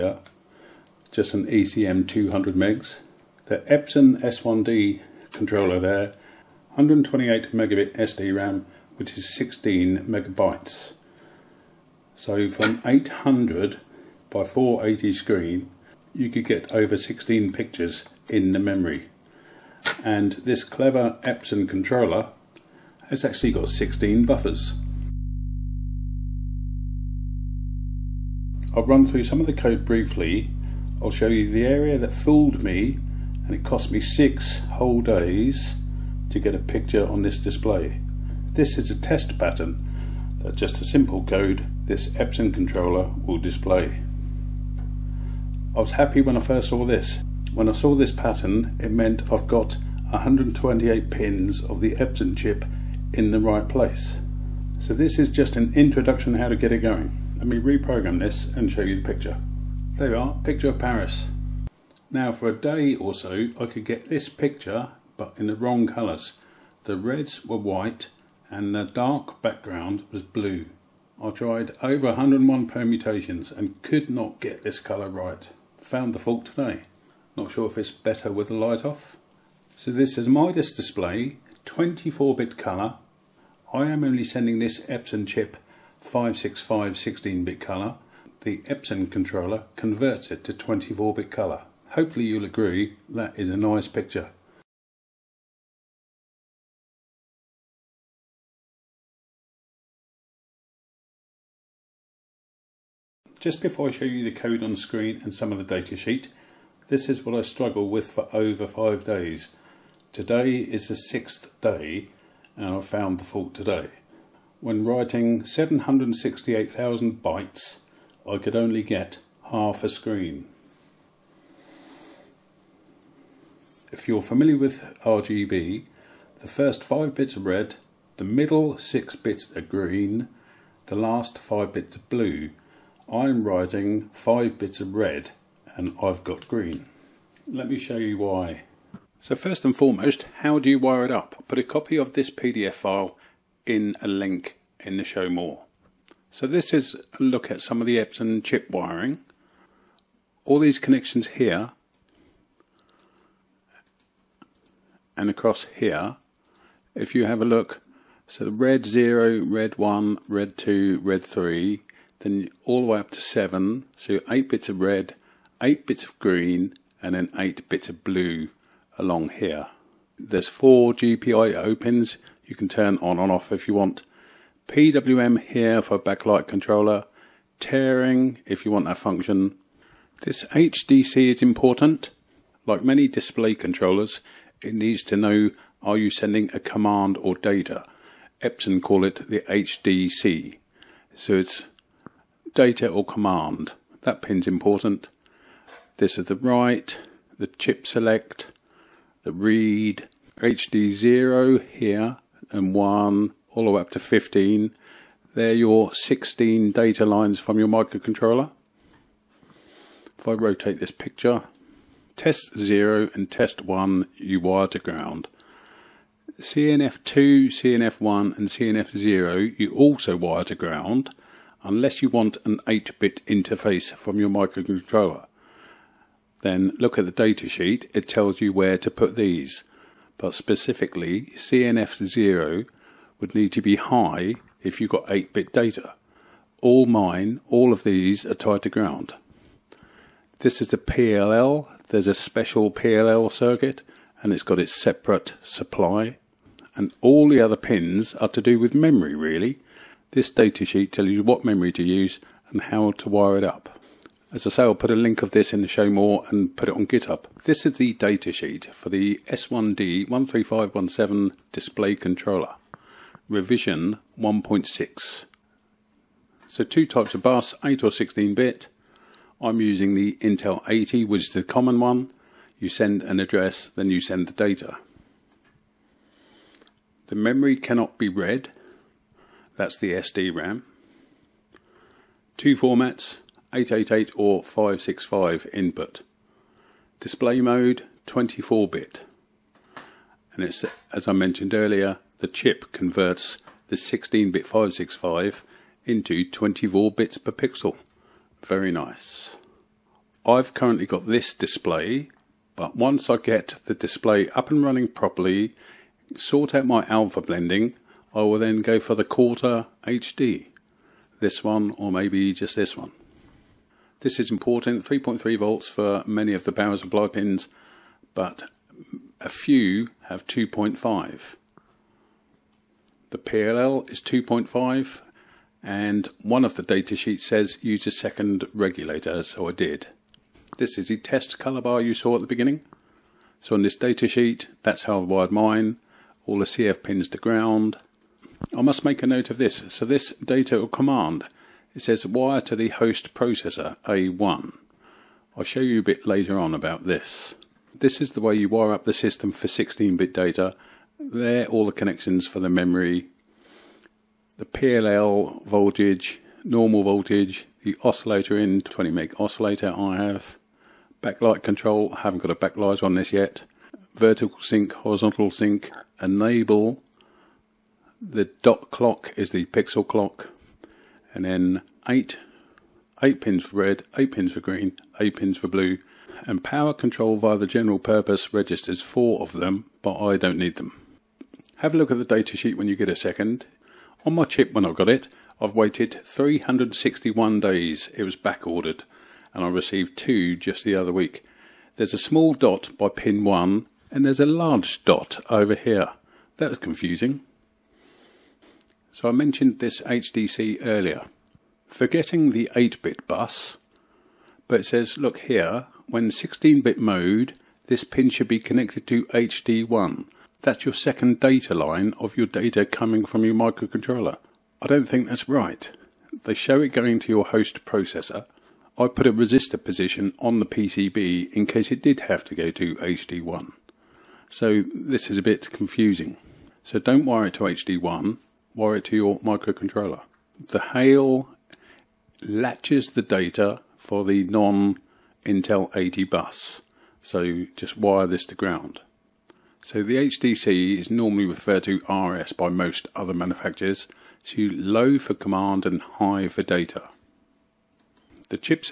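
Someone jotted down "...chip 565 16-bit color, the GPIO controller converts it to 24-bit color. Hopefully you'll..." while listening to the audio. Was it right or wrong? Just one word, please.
wrong.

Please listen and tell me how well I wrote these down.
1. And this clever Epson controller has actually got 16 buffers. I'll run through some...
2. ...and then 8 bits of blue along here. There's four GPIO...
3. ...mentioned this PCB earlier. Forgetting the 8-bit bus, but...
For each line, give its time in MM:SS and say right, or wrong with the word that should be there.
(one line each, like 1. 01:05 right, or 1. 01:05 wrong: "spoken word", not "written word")
1. 00:20 right
2. 02:47 right
3. 06:39 wrong: "HDC", not "PCB".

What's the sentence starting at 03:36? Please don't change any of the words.
CNF2, CNF1 and CNF0 you also wire to ground unless you want an 8-bit interface from your microcontroller.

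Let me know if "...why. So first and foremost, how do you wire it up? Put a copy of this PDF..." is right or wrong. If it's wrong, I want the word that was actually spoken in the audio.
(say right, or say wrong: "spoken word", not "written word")
right.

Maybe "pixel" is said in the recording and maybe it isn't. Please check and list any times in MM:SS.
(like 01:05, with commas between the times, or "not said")
04:57, 06:09.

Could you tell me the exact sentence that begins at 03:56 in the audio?
All mine, all of these are tied to ground.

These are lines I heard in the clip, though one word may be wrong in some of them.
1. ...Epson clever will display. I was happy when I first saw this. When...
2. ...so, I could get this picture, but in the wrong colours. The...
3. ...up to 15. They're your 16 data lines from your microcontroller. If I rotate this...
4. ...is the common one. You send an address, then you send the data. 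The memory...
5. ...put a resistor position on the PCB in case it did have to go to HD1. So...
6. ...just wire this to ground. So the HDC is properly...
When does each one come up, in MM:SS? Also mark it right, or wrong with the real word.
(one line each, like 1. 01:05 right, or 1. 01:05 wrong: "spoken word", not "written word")
1. 00:42 wrong: "controller", not "clever"
2. 01:03 right
3. 03:23 right
4. 04:31 right
5. 06:58 right
6. 07:17 wrong: "normally", not "properly".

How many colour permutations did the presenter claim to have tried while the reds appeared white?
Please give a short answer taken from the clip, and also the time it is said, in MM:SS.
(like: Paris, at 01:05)
101, at 01:12.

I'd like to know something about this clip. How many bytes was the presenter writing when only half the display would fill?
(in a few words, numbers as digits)
768,000.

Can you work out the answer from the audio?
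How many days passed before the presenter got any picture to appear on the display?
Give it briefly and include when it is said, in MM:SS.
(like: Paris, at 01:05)
6, at 00:33.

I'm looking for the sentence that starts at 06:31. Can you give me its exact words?
There's a small dot by pin 1, and there's a large dot over here.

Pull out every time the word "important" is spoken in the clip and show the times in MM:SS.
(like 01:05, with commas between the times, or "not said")
03:01, 03:14, 05:14.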